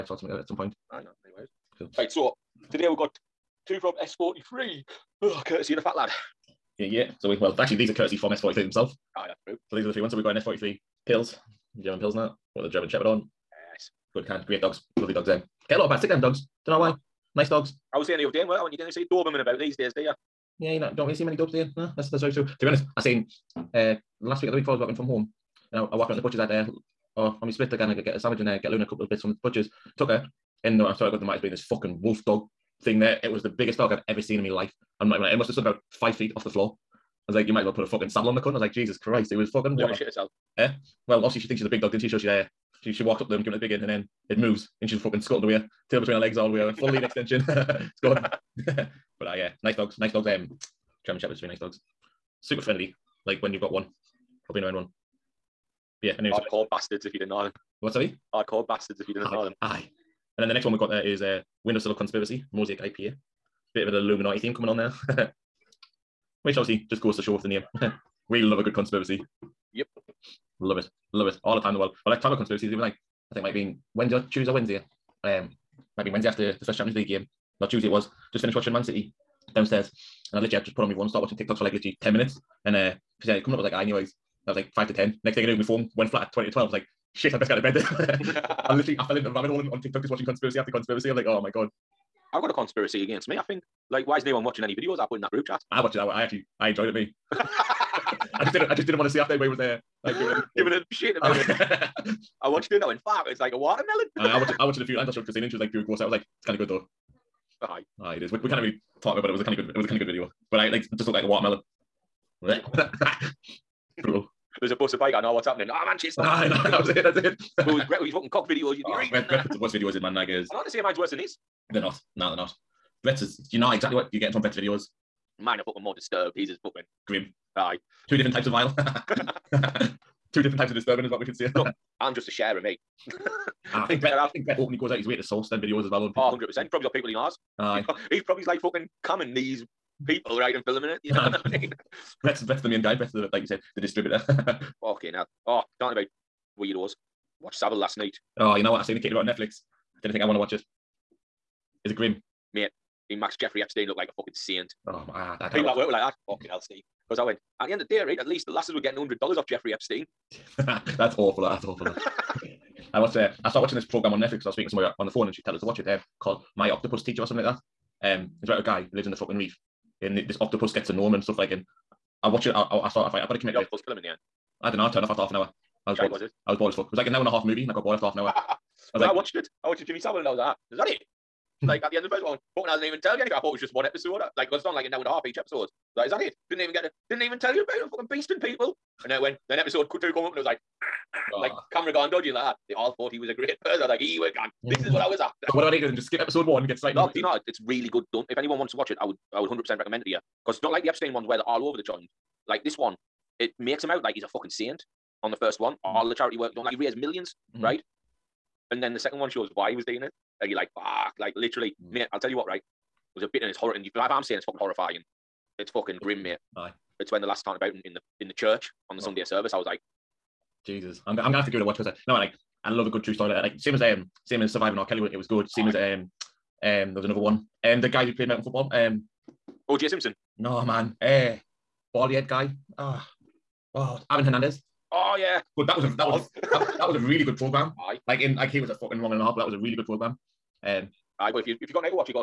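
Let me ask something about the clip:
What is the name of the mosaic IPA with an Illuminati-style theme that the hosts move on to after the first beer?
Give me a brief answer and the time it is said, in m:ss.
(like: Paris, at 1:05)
Windowsill of Conspiracy, at 1:01.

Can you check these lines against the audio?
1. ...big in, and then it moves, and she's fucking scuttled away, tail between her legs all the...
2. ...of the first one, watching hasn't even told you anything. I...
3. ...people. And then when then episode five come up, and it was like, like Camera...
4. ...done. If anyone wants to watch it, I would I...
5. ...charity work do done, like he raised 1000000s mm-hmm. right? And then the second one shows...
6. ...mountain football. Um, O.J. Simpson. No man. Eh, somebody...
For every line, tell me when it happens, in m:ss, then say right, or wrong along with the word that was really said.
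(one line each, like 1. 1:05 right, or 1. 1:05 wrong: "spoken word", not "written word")
1. 0:43 right
2. 3:02 wrong: "fucking", not "watching"
3. 3:08 wrong: "two", not "five"
4. 3:18 right
5. 3:26 right
6. 3:48 wrong: "baldy", not "somebody".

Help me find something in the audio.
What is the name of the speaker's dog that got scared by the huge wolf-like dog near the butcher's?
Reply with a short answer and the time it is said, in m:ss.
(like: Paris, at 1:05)
Luna, at 0:28.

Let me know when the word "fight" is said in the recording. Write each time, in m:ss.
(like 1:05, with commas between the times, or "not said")
2:53.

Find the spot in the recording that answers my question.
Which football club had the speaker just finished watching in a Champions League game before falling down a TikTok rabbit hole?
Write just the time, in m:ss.
1:18.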